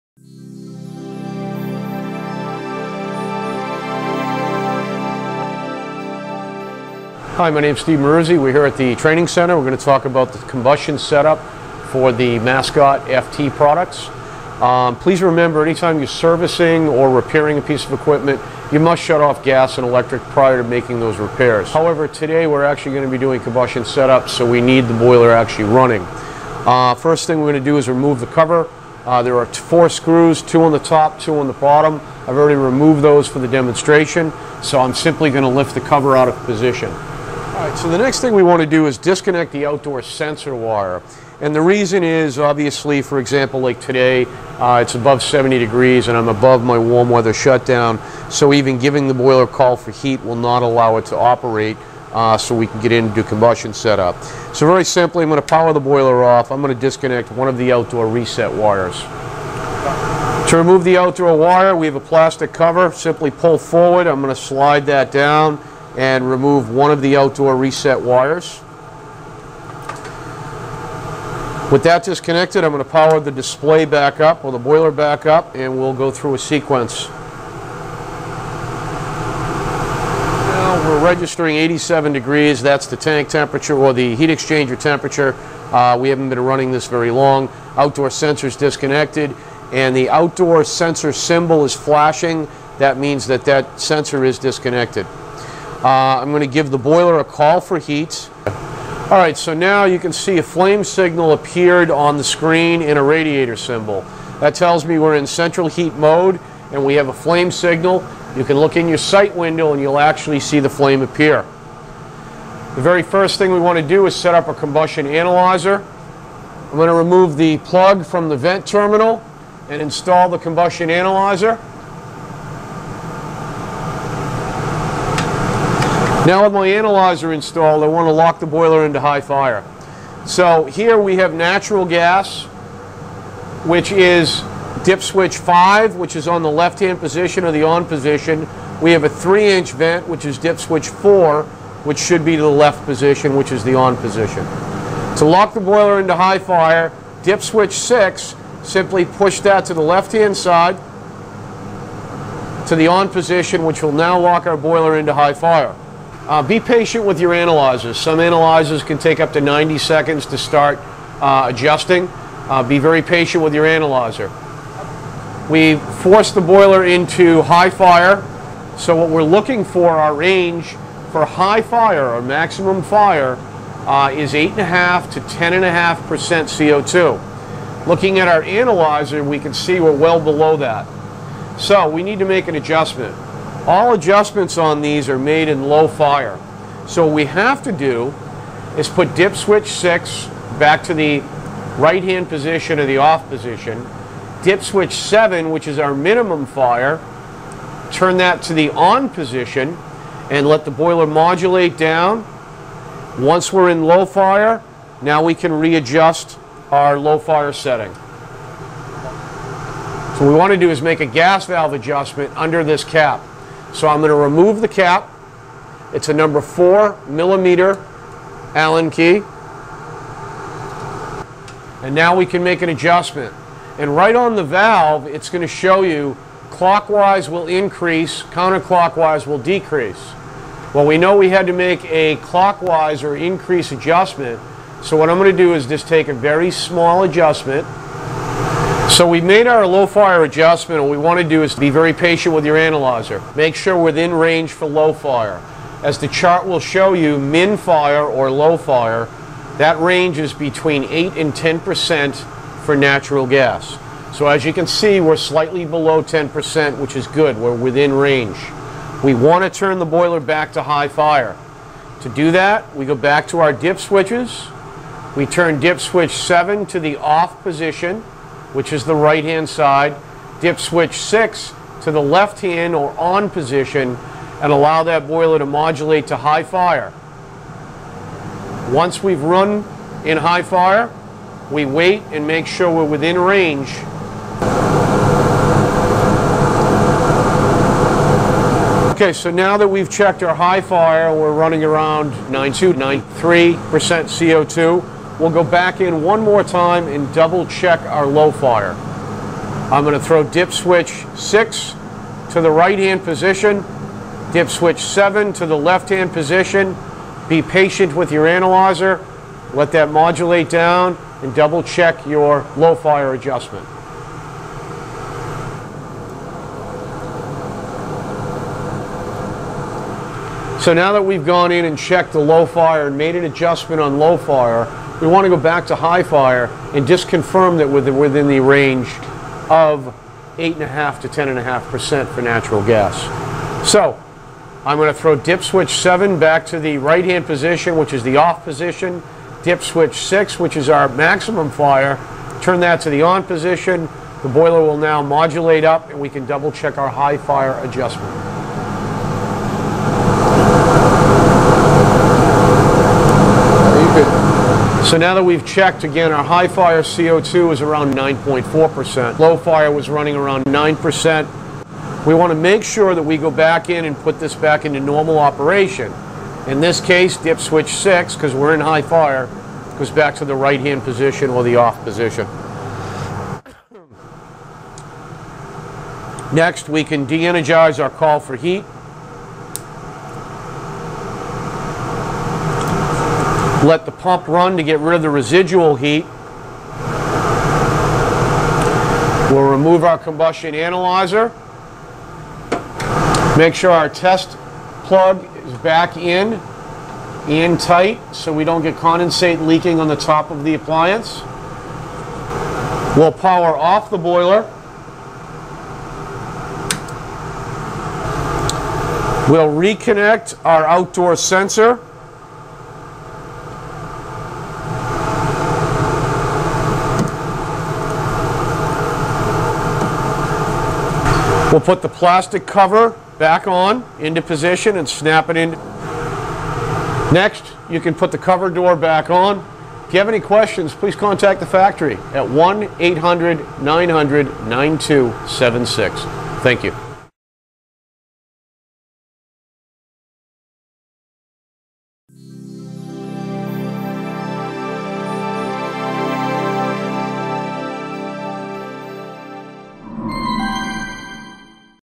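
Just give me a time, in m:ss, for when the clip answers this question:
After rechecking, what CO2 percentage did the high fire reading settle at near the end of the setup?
5:57.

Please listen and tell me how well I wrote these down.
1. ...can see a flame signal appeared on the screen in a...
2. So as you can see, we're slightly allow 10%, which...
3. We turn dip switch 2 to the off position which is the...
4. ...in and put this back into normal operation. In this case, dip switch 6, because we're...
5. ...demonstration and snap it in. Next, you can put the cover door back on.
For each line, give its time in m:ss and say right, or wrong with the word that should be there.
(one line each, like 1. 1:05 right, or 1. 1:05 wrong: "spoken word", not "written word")
1. 1:39 right
2. 4:14 wrong: "below", not "allow"
3. 4:25 wrong: "7", not "2"
4. 6:03 right
5. 7:04 wrong: "position", not "demonstration".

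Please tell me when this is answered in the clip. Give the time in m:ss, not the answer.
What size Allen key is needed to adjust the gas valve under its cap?
3:36.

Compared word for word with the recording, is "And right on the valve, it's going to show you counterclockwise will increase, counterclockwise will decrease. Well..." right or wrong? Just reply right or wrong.
wrong.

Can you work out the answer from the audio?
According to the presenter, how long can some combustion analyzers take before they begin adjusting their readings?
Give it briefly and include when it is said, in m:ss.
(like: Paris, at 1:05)
90 seconds, at 2:39.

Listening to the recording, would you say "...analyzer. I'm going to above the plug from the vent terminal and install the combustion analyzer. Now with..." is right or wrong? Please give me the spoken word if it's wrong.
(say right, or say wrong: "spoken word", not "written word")
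wrong: "remove", not "above".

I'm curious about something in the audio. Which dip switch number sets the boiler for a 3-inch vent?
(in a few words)
4.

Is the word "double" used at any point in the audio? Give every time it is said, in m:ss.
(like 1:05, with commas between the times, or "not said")
4:57, 5:11, 5:46.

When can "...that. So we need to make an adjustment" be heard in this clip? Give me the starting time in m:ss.
3:00.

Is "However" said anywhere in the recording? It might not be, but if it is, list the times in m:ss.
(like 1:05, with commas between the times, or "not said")
0:21.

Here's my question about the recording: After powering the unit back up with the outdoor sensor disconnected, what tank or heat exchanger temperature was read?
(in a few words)
87 degrees.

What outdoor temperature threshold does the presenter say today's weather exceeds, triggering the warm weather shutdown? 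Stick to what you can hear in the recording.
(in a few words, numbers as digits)
70 degrees.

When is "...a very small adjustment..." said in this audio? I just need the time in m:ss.
3:56.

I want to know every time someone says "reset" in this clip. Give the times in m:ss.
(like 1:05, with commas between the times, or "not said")
0:58, 1:07.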